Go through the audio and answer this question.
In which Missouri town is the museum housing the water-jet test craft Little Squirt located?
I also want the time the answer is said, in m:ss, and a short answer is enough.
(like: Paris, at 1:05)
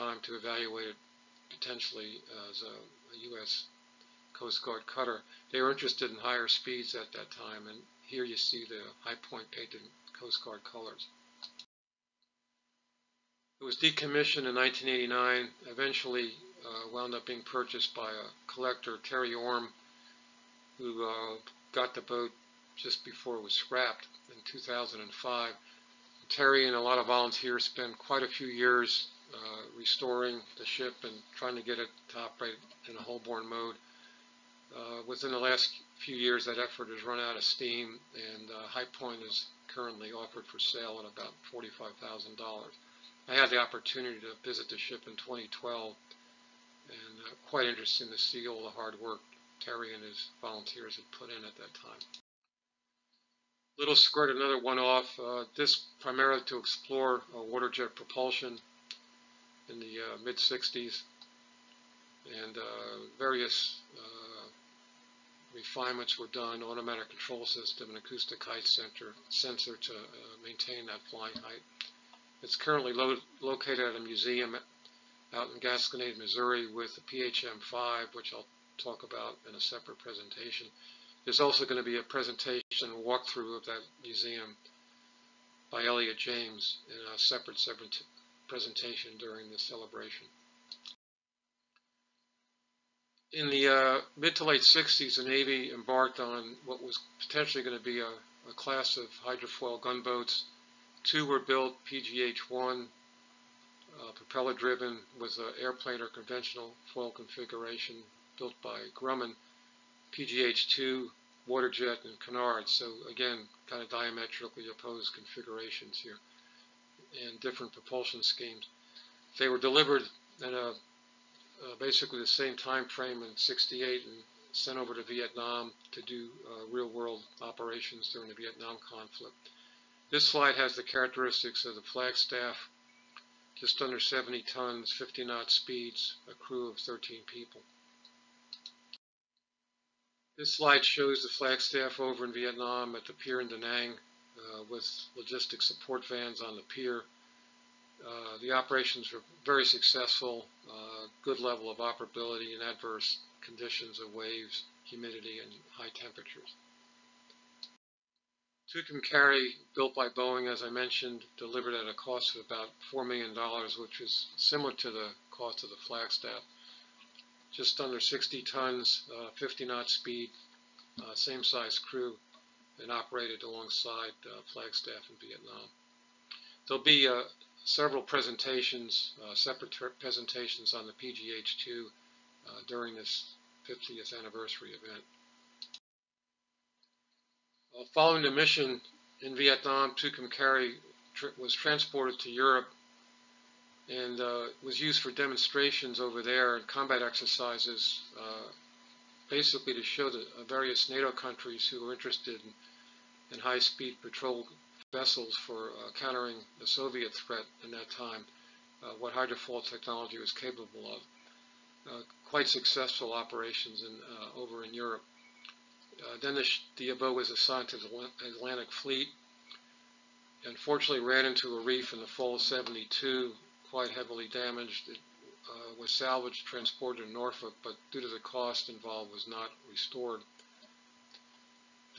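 Gasconade, at 1:15.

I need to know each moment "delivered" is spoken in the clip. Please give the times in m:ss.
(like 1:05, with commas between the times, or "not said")
1:59, 2:41.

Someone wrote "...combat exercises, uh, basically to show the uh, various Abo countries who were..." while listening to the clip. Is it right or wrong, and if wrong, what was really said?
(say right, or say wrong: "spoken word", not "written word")
wrong: "NATO", not "Abo".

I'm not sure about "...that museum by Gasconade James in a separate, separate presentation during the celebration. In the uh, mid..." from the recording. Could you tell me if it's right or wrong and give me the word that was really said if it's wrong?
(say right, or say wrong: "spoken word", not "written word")
wrong: "Elliot", not "Gasconade".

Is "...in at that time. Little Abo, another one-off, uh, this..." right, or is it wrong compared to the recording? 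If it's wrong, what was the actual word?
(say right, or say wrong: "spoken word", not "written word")
wrong: "Squirt", not "Abo".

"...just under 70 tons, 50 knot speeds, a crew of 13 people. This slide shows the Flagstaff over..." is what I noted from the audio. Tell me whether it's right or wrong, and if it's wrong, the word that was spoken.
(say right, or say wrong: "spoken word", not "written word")
right.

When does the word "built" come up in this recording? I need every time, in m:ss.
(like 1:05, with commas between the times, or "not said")
1:41, 1:48, 2:39.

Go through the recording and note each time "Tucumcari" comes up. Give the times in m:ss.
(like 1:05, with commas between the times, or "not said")
2:38, 3:09.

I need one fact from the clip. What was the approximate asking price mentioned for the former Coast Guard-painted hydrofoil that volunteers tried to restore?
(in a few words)
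$45,000.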